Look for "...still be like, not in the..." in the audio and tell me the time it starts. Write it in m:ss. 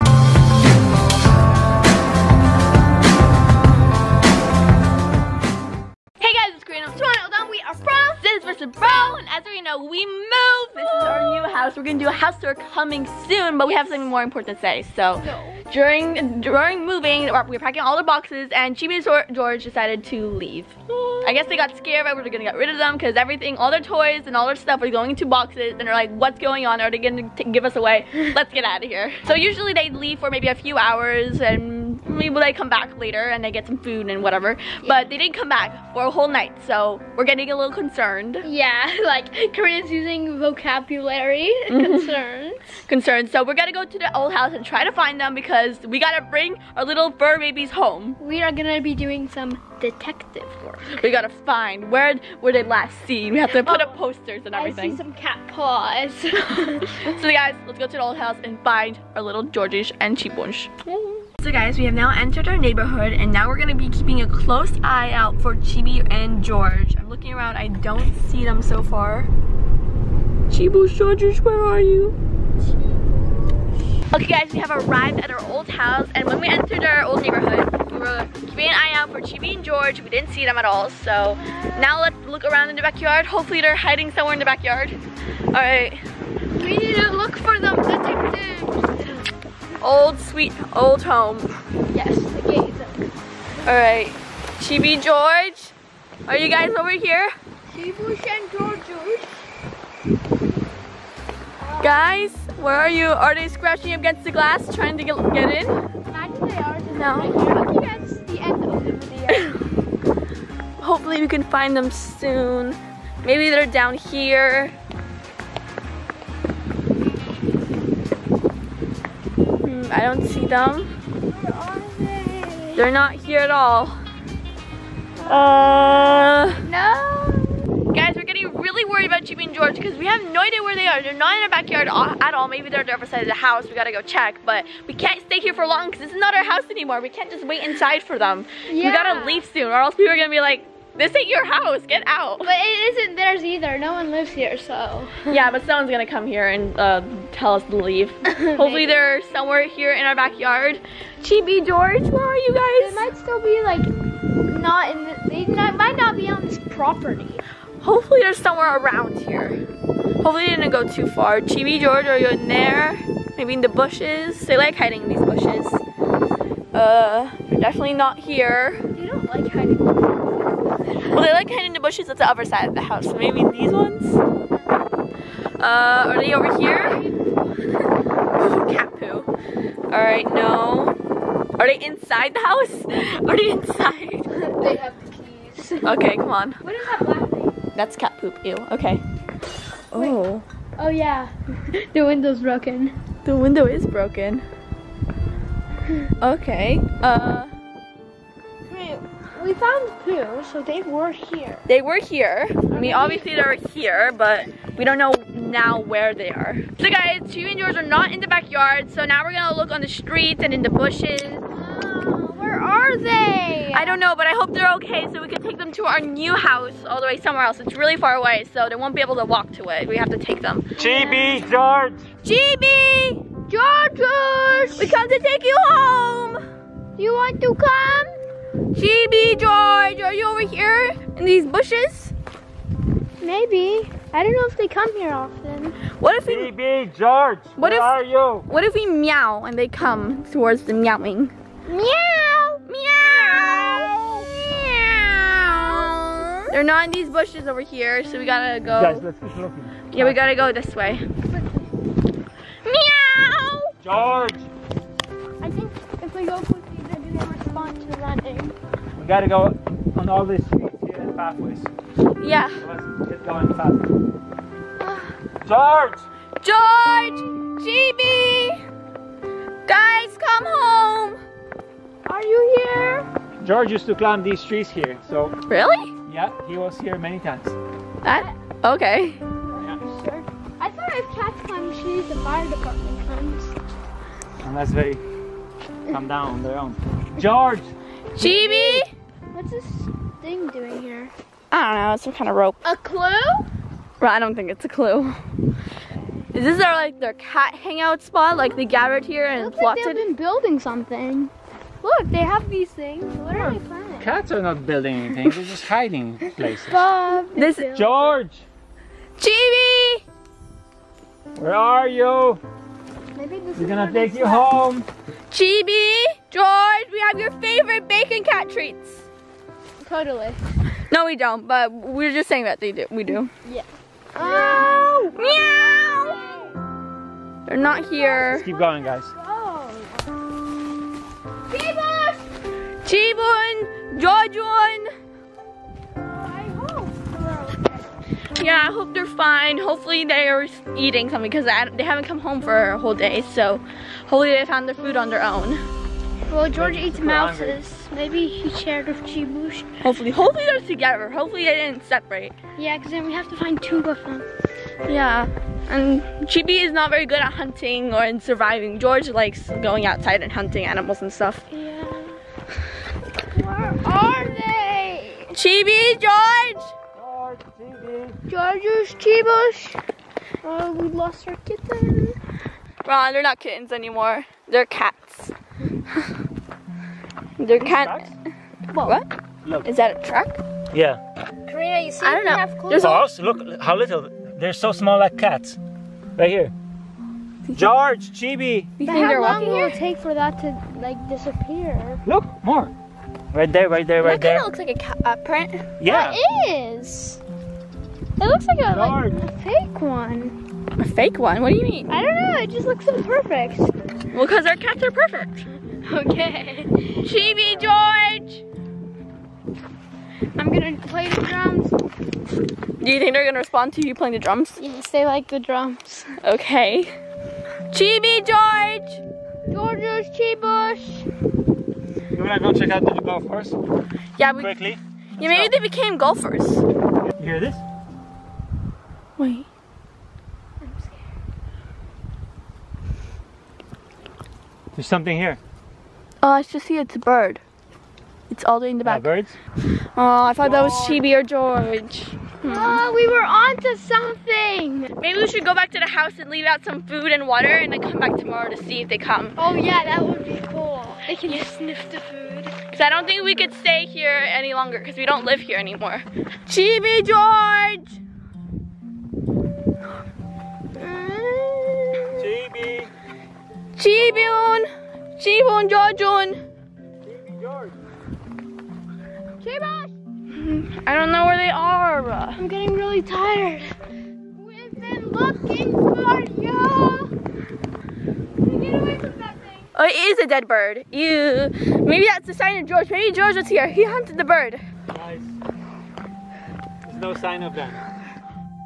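2:33.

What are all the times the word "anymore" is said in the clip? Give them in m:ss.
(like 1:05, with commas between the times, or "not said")
2:16, 6:13, 7:35.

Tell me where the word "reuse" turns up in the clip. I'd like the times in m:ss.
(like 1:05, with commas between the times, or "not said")
not said.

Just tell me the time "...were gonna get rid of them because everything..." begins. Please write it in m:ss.
0:22.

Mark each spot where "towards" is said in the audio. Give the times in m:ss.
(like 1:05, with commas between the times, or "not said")
4:00.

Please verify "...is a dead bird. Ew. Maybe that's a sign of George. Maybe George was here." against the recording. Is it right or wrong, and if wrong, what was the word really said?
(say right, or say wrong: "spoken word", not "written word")
right.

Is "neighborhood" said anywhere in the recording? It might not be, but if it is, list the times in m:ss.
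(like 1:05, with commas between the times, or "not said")
1:02, 1:17.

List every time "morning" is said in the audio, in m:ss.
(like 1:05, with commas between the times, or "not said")
not said.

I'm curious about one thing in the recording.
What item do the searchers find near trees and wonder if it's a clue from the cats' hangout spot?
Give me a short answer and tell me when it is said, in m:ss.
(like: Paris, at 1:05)
Rope, at 4:52.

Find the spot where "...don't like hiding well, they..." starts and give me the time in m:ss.
2:49.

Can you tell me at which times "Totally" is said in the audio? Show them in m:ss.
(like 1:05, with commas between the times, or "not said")
5:19.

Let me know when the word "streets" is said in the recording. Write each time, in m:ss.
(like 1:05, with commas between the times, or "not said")
3:29, 4:20.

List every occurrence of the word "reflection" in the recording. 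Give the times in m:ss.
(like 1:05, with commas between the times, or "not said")
not said.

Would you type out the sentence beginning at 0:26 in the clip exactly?
Are they gonna give us away?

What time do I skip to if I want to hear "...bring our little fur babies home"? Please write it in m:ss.
0:46.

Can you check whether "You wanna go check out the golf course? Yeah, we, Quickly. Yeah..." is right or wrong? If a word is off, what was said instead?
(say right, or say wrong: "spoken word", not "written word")
right.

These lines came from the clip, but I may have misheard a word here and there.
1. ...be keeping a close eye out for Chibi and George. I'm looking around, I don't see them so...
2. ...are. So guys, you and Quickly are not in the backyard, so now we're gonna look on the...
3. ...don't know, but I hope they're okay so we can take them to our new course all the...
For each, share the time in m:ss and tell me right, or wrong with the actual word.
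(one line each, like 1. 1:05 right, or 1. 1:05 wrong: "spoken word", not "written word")
1. 1:03 right
2. 3:26 wrong: "George", not "Quickly"
3. 3:33 wrong: "house", not "course".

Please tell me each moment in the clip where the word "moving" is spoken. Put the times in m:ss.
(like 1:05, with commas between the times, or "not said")
0:16.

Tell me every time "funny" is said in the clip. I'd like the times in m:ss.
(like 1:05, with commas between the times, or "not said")
not said.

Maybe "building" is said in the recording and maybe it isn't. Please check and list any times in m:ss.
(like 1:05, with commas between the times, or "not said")
5:00, 5:04.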